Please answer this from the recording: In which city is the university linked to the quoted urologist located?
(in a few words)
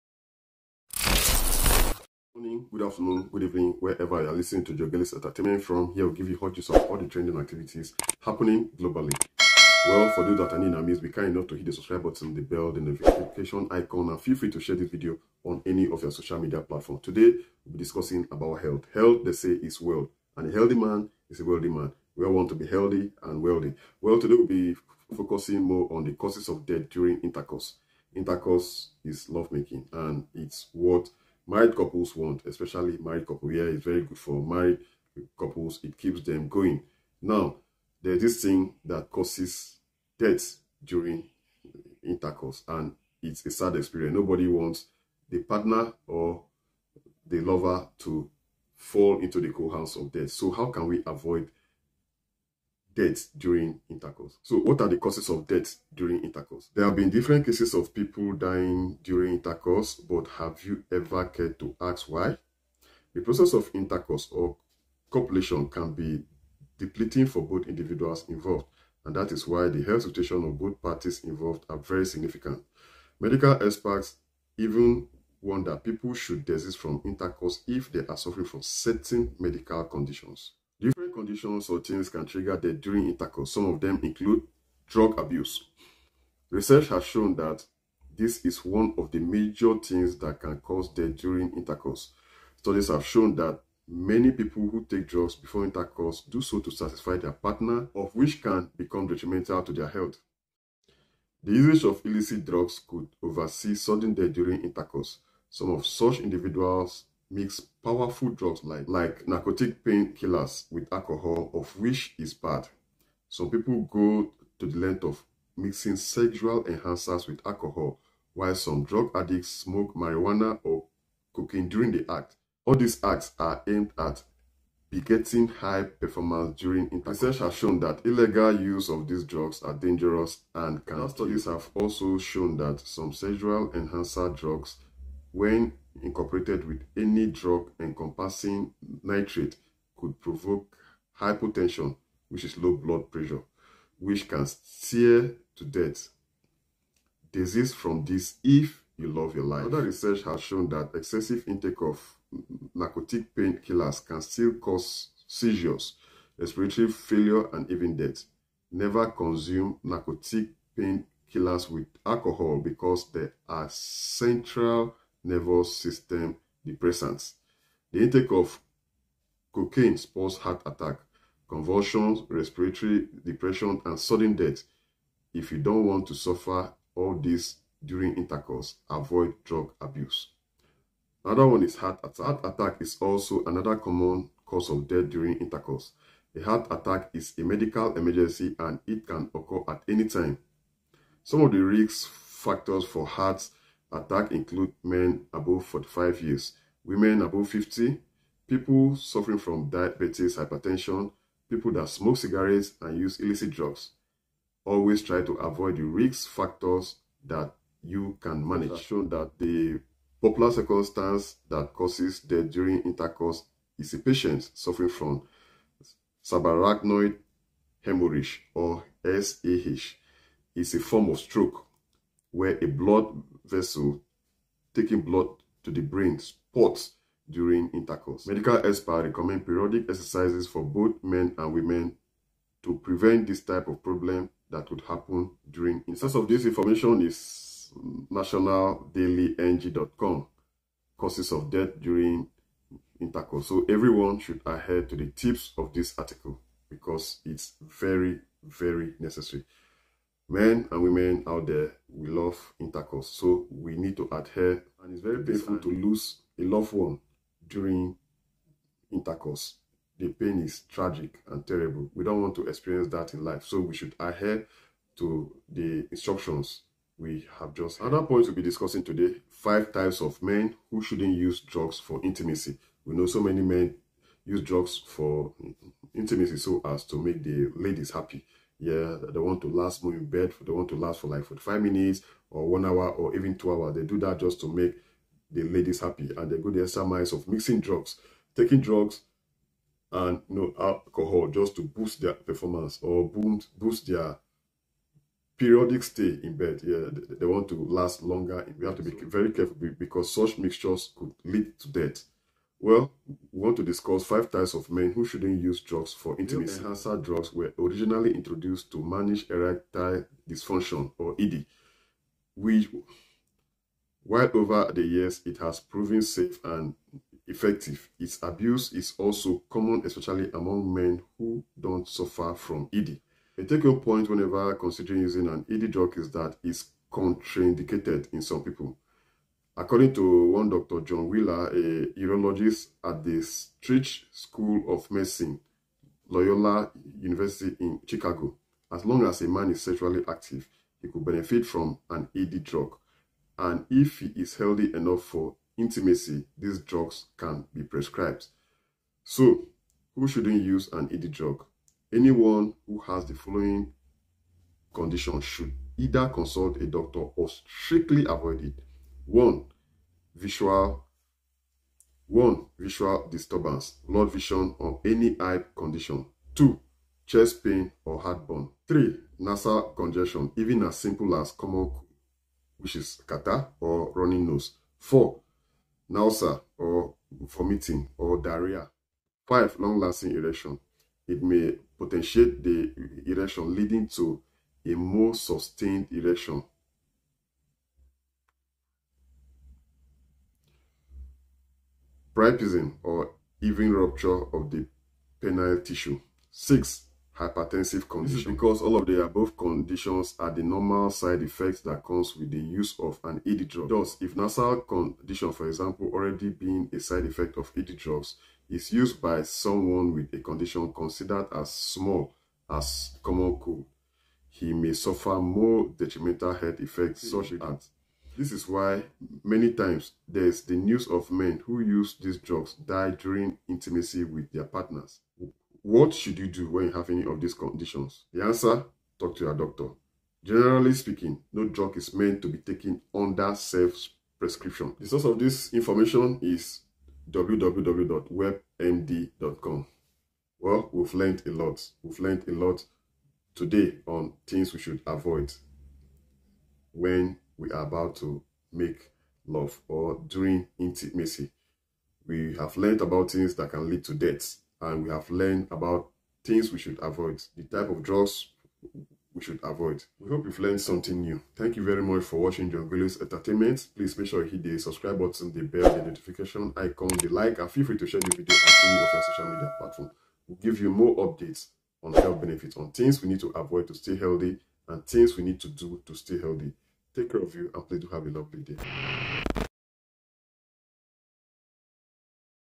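Chicago.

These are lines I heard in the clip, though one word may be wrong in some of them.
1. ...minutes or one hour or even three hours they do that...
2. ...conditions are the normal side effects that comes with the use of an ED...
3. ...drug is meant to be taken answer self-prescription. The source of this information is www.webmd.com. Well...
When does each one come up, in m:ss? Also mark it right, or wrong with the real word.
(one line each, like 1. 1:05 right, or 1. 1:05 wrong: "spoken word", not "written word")
1. 4:41 wrong: "two", not "three"
2. 6:39 right
3. 7:11 wrong: "under", not "answer".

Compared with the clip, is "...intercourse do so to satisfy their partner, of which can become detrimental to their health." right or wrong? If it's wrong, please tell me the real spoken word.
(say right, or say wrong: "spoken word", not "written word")
right.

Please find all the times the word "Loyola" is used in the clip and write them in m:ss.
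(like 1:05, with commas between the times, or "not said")
5:36.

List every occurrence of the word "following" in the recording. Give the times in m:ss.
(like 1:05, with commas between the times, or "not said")
5:53.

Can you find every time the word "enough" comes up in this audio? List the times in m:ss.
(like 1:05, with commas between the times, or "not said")
0:11, 5:44.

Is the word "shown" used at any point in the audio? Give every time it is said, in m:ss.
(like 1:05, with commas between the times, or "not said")
1:27, 1:33, 2:07, 2:12, 2:30, 3:28.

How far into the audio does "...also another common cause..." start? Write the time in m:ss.
3:02.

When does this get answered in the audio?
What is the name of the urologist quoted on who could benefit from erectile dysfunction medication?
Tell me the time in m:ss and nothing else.
5:30.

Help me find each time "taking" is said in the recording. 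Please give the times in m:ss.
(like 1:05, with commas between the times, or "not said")
3:44, 4:48.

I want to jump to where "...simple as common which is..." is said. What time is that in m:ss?
6:10.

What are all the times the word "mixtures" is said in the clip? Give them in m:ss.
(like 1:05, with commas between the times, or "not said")
5:00.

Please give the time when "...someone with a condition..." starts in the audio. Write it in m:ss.
6:49.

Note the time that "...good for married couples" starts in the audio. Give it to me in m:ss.
0:34.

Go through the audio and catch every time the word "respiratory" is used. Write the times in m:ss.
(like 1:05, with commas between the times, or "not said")
2:36, 2:52.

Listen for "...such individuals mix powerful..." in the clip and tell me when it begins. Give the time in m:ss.
1:45.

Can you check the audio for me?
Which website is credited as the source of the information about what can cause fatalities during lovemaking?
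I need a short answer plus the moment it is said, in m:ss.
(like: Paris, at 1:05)
nationaldailyng.com, at 3:58.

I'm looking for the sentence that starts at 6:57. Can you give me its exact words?
such as this is why many times there's the news of men who use these drugs die during intimacy with their partners.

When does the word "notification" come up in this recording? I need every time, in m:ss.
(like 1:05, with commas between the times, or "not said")
0:12, 7:45.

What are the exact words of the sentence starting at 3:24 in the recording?
Always try to avoid the risk factors that you can manage.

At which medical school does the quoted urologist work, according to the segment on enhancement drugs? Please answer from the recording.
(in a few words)
Stritch School of Medicine.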